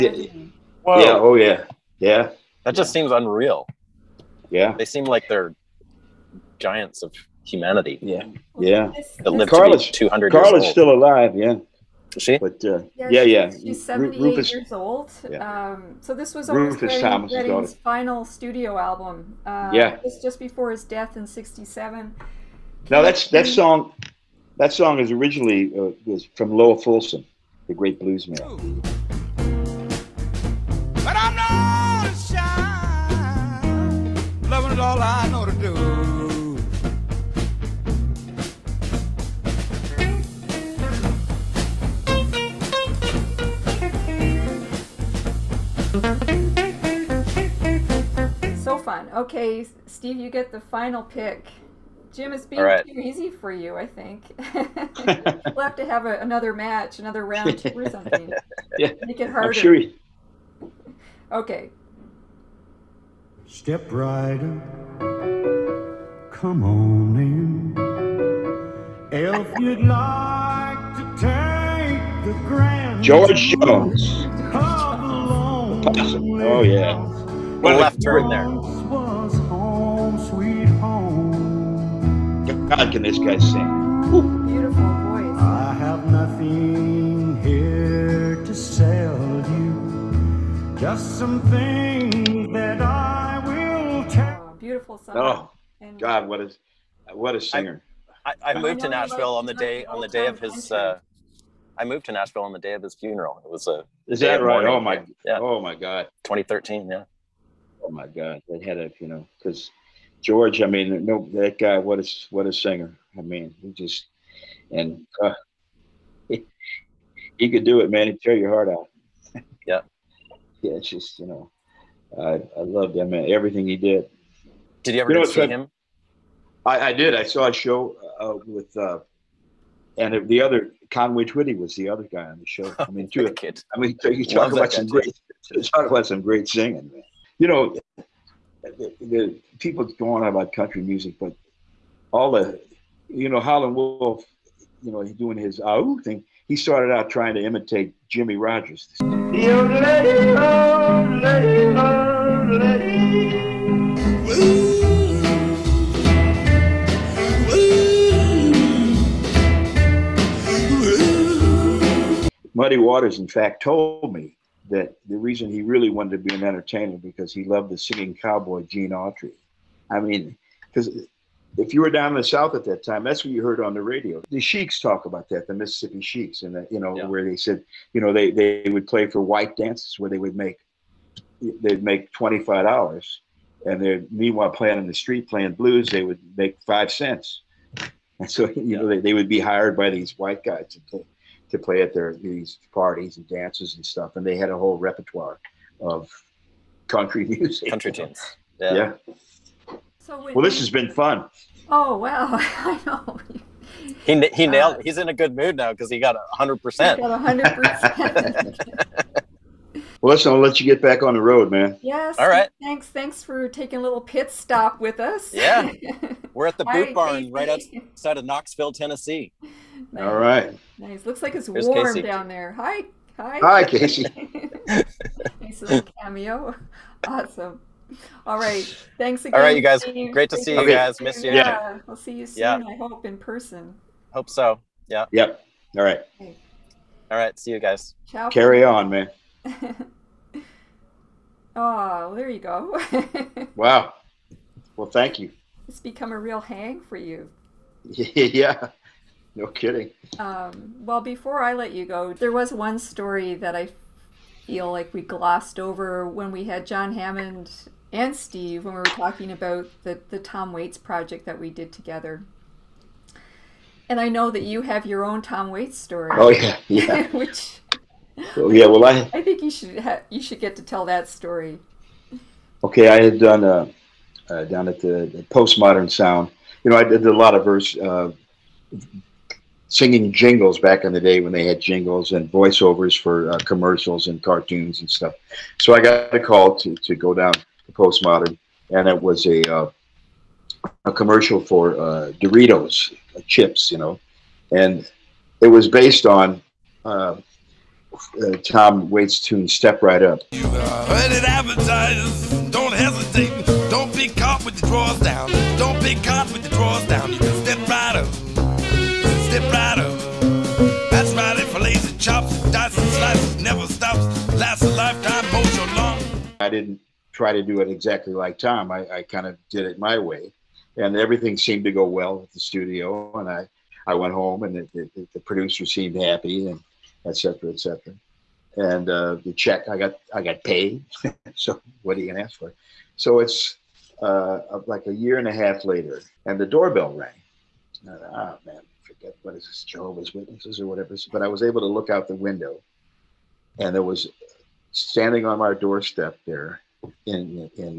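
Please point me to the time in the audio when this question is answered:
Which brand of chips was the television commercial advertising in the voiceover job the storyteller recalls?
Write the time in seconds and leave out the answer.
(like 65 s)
292 s.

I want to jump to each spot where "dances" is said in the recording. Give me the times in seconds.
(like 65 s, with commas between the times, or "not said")
179 s, 193 s.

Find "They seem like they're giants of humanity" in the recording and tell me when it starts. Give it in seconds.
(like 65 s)
4 s.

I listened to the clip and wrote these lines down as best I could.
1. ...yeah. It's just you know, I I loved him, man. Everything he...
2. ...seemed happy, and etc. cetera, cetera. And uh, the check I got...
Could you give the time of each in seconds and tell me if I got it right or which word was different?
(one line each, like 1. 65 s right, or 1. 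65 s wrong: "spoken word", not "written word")
1. 120 s right
2. 325 s right.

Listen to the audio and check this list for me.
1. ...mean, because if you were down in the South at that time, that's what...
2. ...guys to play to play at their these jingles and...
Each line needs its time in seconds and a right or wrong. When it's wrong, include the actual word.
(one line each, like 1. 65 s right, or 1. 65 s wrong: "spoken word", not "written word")
1. 169 s right
2. 190 s wrong: "parties", not "jingles".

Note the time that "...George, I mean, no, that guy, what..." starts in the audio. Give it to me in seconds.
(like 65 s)
110 s.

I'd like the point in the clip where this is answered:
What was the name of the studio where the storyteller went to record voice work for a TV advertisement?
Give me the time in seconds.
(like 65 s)
275 s.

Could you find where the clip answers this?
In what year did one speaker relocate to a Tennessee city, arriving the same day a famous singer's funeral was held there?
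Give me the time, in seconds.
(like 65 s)
106 s.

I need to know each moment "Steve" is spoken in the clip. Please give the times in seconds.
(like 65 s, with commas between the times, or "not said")
49 s, 258 s.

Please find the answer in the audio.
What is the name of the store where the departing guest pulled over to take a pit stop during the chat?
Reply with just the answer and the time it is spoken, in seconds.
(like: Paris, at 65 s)
Boot Barn, at 216 s.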